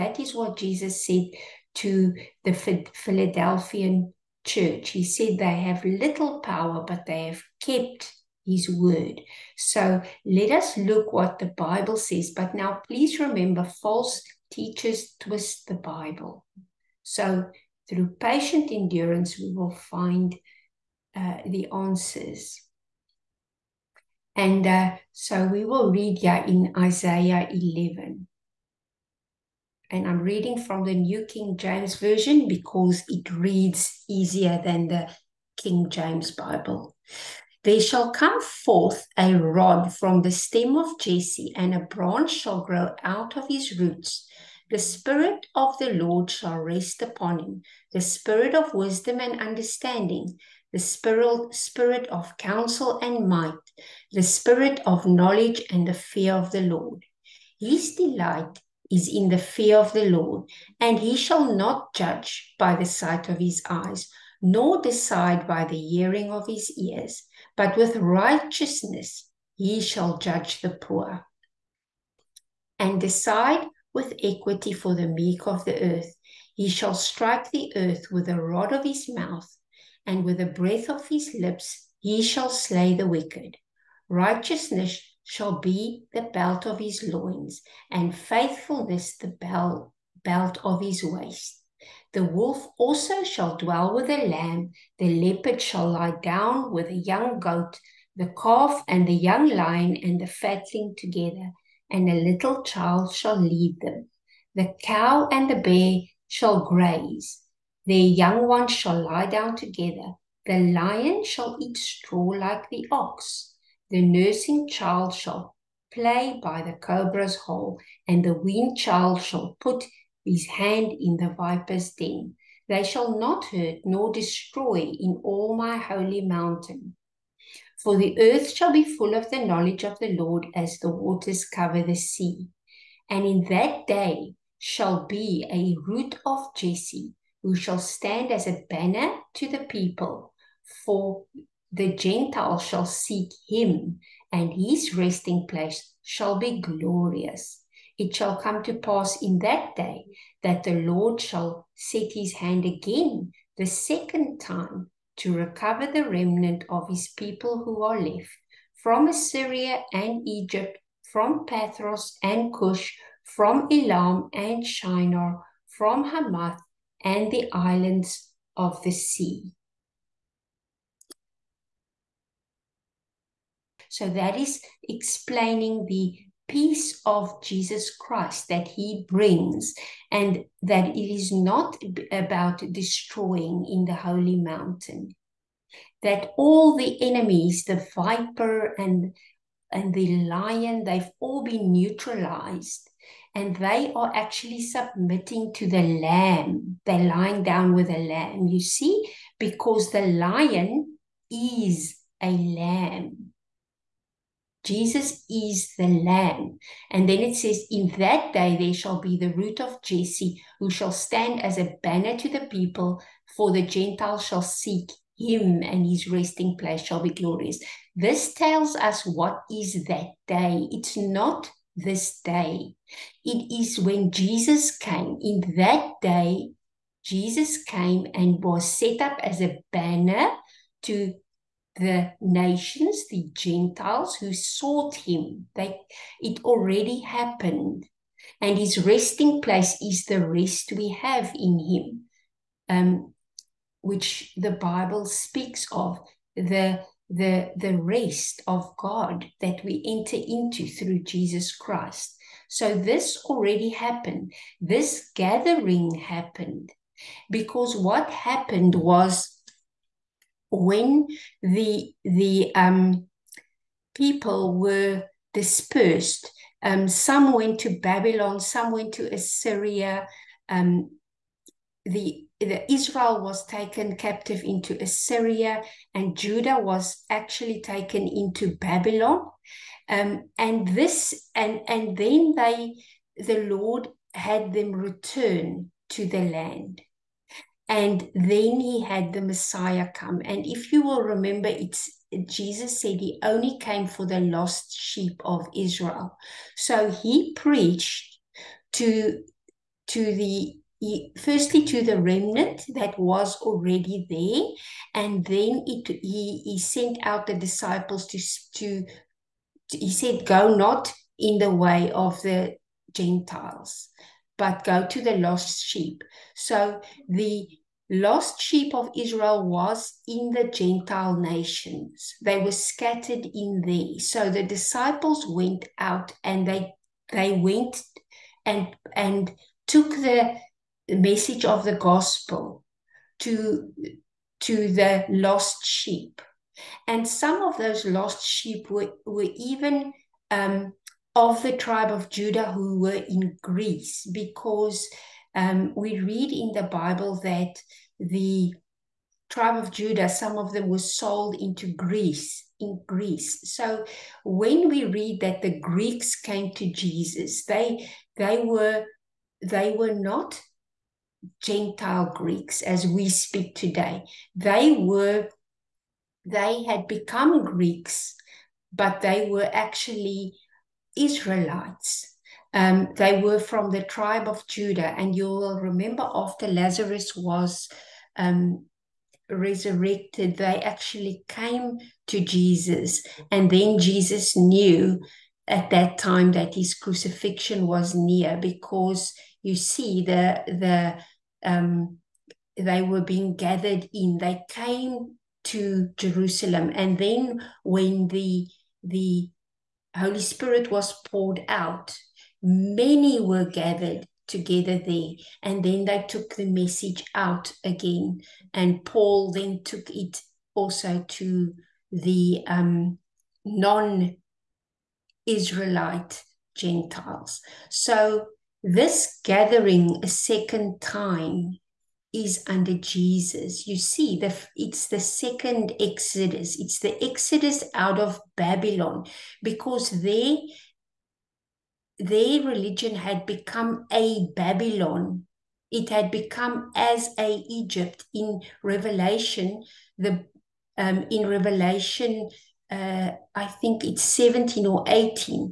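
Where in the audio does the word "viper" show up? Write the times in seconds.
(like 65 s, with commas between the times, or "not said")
121 s, 187 s.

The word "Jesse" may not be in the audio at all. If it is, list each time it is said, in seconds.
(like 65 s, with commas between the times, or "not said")
40 s, 136 s, 209 s.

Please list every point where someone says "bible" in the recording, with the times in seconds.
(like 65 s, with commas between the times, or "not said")
11 s, 15 s, 36 s, 244 s, 346 s.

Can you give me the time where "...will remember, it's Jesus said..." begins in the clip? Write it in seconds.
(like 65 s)
290 s.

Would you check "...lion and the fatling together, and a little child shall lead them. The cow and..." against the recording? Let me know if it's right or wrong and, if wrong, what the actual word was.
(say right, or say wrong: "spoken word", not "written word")
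right.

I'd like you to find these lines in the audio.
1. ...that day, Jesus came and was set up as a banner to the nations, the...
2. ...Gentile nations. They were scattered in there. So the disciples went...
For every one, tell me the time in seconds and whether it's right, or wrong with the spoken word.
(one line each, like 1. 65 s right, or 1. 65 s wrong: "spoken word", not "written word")
1. 225 s right
2. 320 s right.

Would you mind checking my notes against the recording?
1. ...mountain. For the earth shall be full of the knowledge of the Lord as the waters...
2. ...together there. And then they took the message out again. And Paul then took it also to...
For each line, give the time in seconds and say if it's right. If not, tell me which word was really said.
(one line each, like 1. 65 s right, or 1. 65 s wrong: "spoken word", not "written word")
1. 126 s right
2. 404 s right.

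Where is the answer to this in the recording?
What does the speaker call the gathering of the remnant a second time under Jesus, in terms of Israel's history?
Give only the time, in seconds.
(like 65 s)
424 s.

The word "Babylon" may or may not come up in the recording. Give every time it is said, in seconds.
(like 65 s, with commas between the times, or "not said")
267 s, 278 s, 428 s, 434 s.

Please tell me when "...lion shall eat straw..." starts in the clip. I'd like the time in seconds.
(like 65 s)
110 s.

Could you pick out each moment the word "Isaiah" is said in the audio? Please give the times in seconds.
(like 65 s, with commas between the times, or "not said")
26 s.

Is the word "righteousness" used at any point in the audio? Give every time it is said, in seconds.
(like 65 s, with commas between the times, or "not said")
67 s, 84 s.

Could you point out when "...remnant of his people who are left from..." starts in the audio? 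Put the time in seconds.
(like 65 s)
156 s.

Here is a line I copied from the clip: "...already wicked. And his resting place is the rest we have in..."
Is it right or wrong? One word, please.
wrong.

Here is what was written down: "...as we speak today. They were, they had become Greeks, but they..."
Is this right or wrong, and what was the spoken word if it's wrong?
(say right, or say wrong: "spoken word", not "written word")
right.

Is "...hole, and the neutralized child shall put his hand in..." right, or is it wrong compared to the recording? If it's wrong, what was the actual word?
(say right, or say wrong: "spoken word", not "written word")
wrong: "weaned", not "neutralized".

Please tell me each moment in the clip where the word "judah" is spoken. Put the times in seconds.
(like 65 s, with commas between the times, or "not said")
276 s, 342 s, 349 s, 374 s.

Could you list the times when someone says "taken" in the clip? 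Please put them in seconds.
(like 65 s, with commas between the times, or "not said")
273 s, 277 s.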